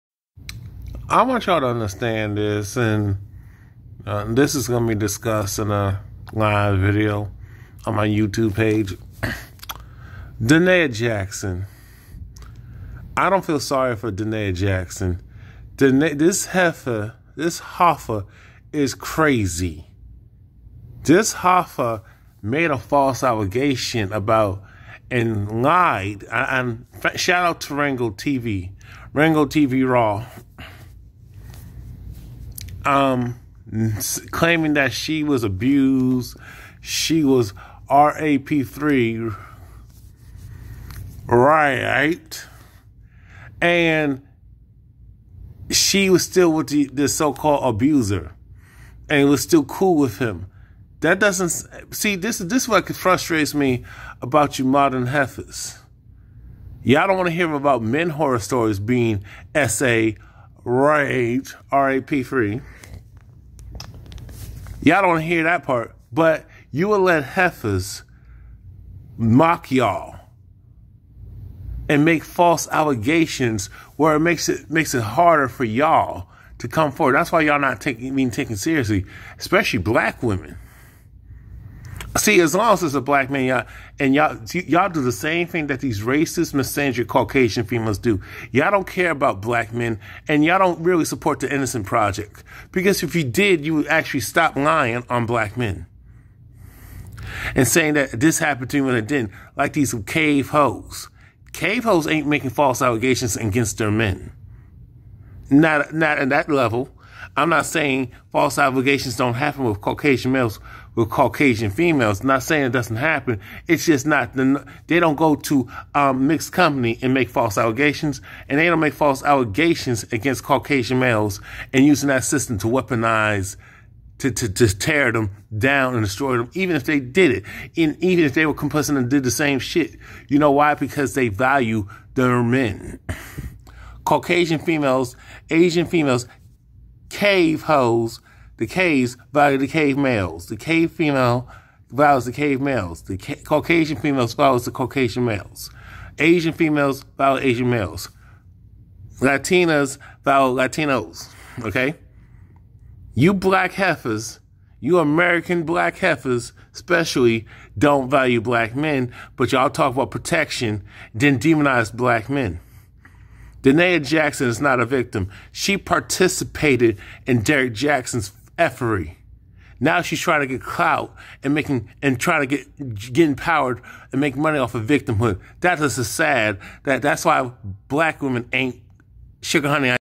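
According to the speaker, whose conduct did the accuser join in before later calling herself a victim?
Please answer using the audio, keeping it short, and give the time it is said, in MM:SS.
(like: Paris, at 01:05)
Derrick Jaxn, at 02:47.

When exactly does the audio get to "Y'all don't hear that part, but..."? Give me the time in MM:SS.
01:04.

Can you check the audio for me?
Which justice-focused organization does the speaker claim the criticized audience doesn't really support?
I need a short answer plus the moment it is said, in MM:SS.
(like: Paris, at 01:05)
Innocent Project, at 01:31.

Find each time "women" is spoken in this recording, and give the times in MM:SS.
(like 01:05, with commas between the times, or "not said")
01:20, 02:58.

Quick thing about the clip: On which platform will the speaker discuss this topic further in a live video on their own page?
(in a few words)
YouTube.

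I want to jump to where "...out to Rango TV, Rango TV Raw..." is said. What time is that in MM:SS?
00:27.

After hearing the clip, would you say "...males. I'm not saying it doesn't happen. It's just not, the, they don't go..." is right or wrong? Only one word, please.
wrong.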